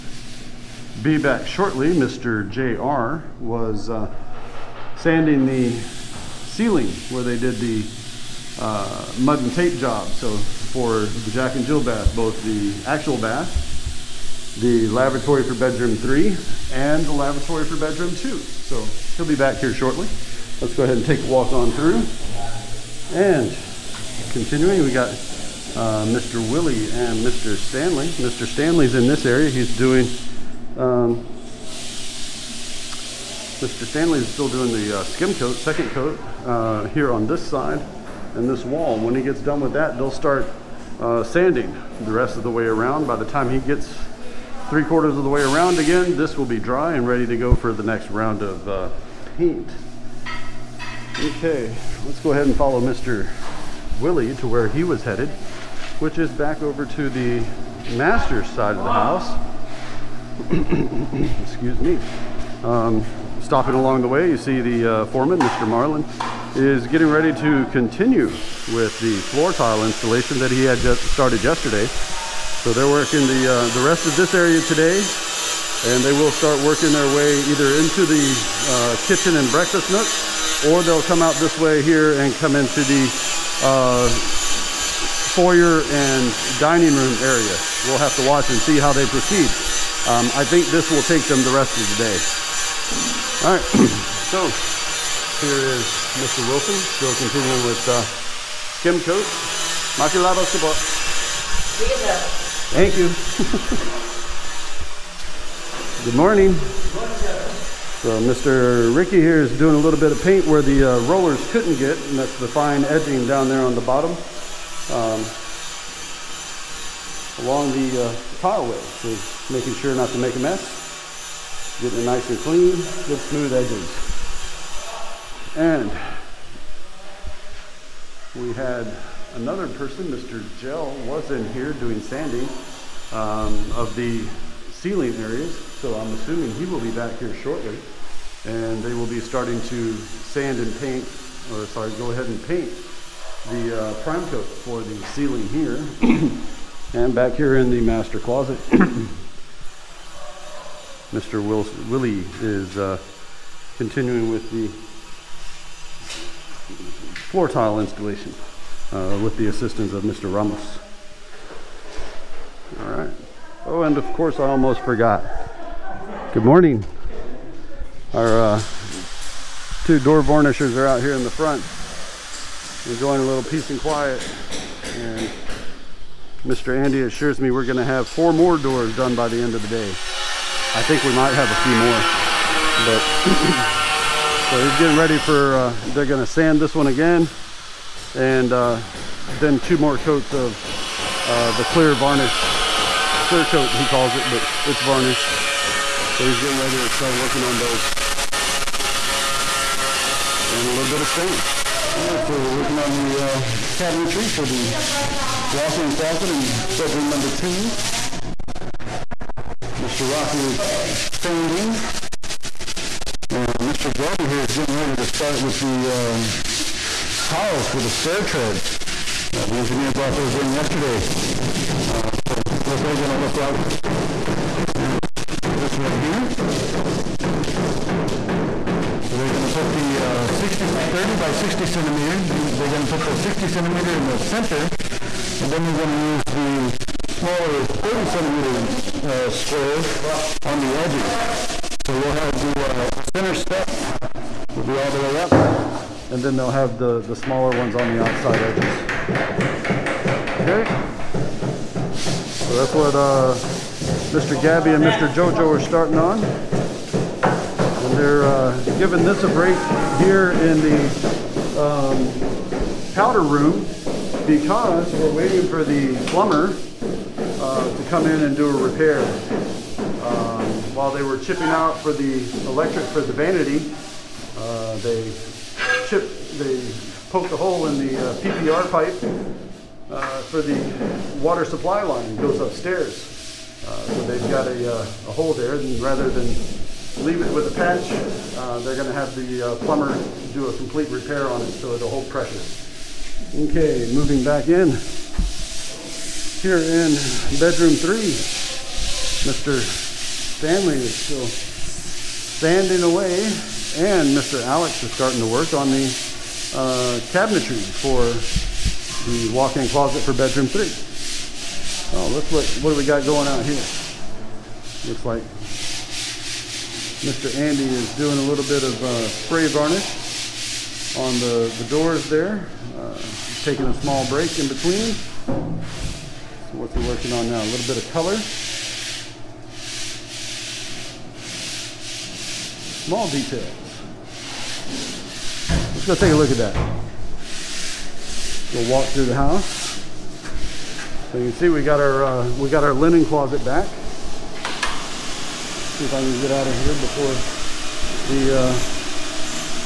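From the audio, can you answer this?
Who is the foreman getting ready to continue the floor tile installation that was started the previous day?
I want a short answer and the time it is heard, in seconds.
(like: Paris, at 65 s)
Mr. Marlin, at 65 s.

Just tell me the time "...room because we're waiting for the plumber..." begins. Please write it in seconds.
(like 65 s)
263 s.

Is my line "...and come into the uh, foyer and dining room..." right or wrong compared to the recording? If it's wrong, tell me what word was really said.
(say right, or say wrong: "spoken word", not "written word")
right.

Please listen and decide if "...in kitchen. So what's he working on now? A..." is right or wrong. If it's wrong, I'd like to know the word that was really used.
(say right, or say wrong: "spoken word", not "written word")
wrong: "between", not "kitchen".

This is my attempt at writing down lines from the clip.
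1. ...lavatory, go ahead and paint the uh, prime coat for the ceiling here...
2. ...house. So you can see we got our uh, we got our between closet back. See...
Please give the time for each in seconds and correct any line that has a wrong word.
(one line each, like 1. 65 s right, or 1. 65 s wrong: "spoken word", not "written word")
1. 141 s wrong: "sorry", not "lavatory"
2. 339 s wrong: "linen", not "between".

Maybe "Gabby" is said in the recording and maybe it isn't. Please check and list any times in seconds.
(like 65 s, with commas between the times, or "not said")
213 s, 254 s.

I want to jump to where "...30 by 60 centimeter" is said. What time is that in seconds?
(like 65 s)
230 s.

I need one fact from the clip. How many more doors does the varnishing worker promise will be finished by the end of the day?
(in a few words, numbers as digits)
4.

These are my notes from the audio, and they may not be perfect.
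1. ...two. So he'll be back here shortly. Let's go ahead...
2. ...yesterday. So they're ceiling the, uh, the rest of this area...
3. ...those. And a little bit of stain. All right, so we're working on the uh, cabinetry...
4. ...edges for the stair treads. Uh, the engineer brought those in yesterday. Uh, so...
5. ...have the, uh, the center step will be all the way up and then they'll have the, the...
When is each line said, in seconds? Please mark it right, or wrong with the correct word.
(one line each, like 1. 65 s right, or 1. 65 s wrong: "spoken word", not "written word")
1. 18 s right
2. 71 s wrong: "working", not "ceiling"
3. 197 s right
4. 217 s wrong: "tiles", not "edges"
5. 242 s right.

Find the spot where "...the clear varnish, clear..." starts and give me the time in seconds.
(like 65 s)
191 s.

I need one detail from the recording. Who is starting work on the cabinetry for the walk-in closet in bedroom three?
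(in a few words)
Mr. Alex.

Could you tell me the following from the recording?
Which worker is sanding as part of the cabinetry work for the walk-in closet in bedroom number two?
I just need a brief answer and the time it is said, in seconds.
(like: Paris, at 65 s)
Mr. Roth, at 209 s.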